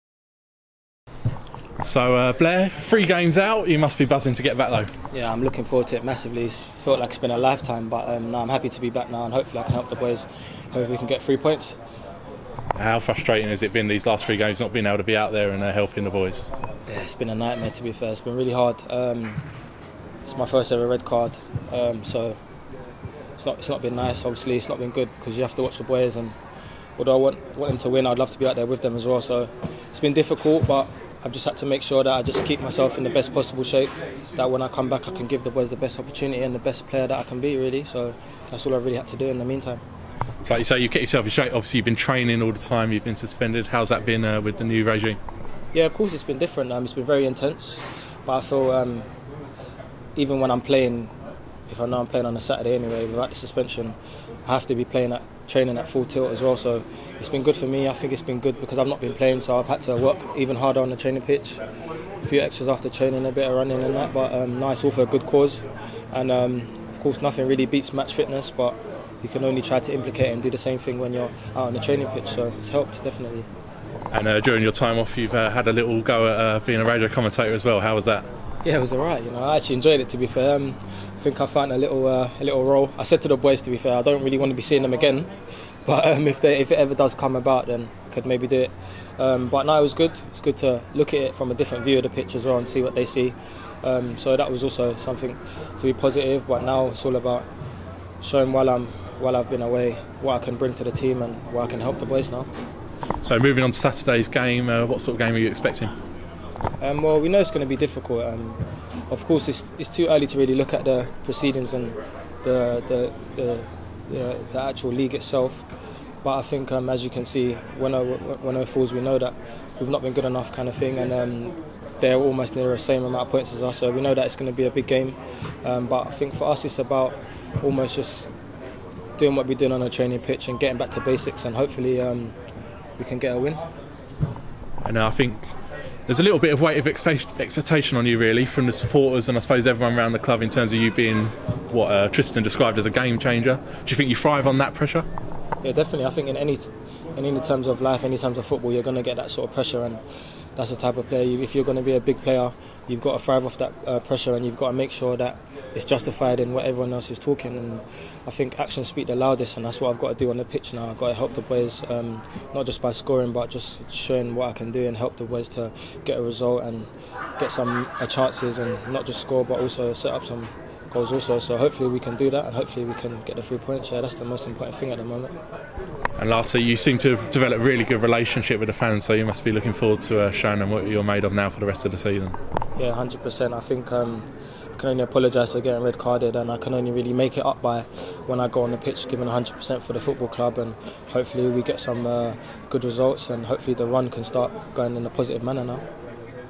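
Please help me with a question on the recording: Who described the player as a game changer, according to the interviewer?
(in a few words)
Tristan.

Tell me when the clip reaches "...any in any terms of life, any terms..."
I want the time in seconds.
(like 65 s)
146 s.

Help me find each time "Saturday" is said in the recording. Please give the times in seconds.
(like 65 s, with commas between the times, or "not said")
52 s, 103 s.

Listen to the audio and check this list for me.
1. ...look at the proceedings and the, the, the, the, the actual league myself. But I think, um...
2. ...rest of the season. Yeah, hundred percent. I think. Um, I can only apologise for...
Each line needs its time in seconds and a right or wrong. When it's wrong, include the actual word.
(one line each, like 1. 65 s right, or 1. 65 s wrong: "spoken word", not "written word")
1. 110 s wrong: "itself", not "myself"
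2. 181 s right.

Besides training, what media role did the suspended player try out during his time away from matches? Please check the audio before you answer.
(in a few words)
Radio commentator.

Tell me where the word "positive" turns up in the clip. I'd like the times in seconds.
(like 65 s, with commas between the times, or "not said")
95 s, 195 s.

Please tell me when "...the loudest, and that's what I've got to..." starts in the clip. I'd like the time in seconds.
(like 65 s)
159 s.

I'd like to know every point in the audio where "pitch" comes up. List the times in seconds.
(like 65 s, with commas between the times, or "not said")
61 s, 72 s, 92 s, 130 s, 160 s, 188 s.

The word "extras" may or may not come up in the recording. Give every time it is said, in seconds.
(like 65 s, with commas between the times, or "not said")
62 s.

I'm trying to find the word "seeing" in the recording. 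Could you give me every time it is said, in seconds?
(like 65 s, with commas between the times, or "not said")
84 s.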